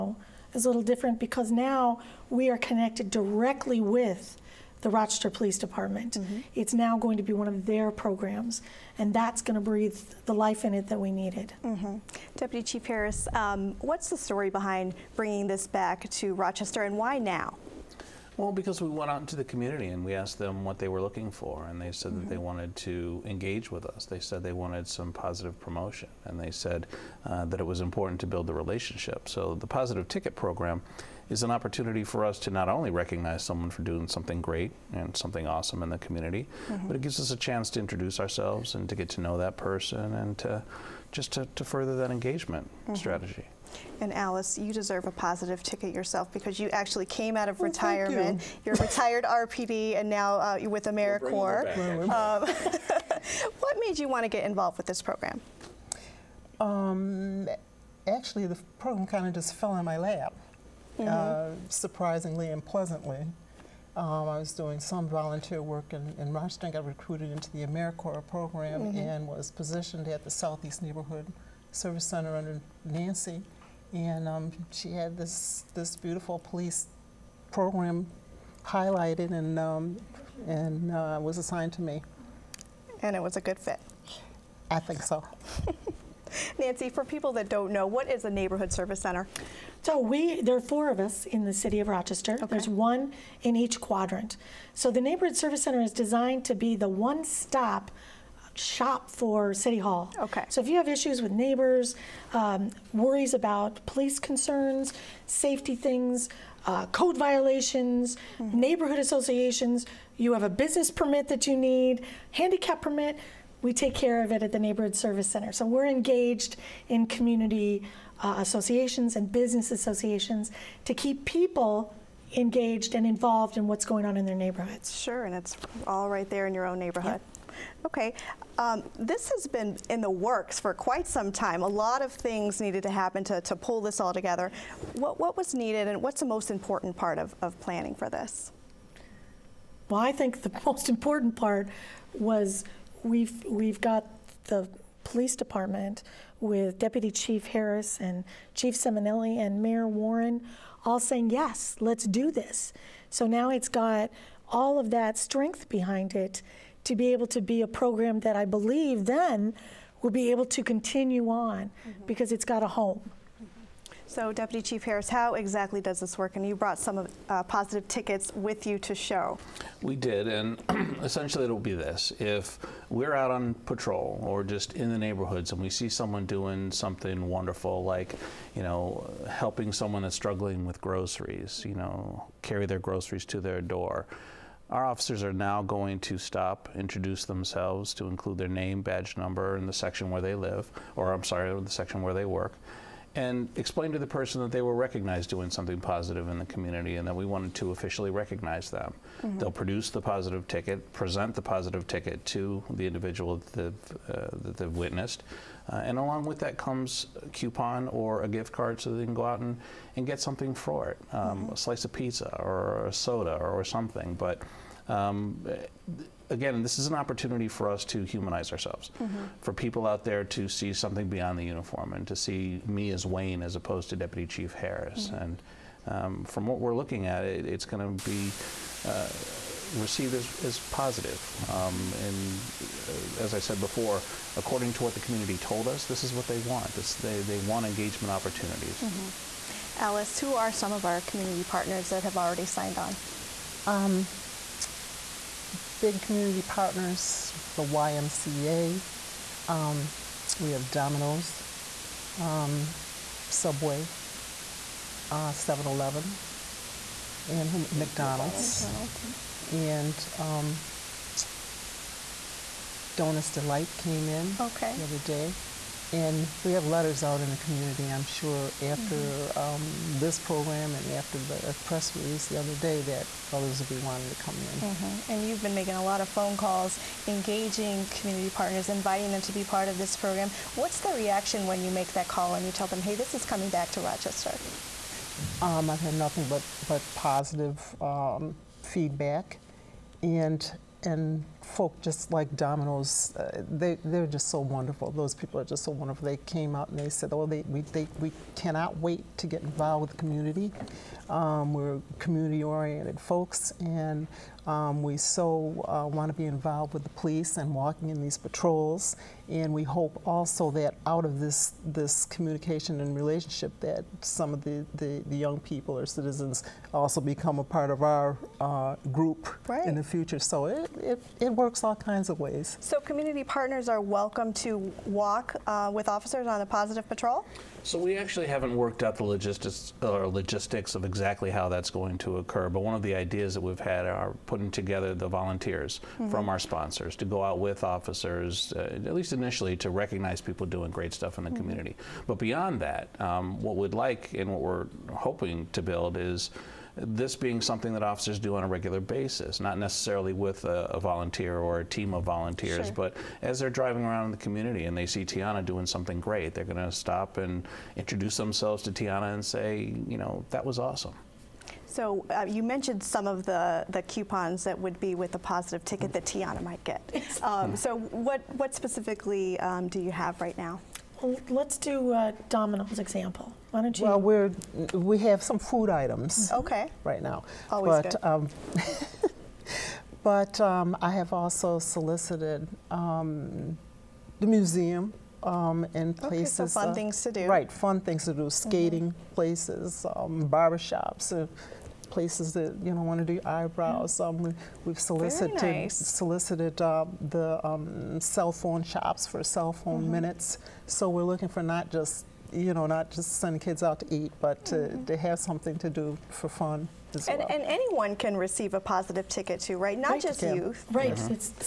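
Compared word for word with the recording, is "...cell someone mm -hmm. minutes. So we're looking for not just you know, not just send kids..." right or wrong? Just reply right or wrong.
wrong.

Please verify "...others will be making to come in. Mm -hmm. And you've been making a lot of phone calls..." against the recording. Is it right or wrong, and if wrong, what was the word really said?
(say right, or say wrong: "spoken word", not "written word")
wrong: "wanting", not "making".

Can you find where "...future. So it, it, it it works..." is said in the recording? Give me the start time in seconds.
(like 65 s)
319 s.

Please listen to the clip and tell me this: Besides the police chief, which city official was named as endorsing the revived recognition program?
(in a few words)
Mayor Warren.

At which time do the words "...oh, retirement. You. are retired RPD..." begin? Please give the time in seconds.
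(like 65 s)
47 s.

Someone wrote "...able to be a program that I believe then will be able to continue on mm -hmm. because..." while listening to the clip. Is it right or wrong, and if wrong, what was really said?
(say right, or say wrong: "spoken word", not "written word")
right.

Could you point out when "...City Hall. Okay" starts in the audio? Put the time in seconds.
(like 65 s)
99 s.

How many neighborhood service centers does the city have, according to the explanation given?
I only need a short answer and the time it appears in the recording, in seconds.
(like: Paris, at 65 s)
4, at 90 s.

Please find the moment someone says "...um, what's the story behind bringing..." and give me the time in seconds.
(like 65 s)
13 s.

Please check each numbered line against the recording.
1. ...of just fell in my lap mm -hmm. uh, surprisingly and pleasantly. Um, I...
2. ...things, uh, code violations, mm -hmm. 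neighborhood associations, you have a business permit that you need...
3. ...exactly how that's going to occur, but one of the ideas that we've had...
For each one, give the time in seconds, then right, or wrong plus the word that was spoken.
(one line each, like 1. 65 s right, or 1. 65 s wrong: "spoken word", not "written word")
1. 59 s right
2. 105 s right
3. 330 s right.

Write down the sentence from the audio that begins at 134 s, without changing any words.
What, what was needed and what's the most important part of, of planning for this?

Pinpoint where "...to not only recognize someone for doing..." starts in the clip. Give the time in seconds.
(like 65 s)
32 s.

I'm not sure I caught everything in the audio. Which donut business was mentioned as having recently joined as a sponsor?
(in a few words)
Donuts Delight.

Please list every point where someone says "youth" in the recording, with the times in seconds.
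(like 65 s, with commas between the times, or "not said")
410 s.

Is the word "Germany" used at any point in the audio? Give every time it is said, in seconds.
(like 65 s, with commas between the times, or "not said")
not said.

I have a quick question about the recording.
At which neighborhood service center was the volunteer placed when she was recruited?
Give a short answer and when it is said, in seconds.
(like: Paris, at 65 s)
Southeast Neighborhood Service Center, at 70 s.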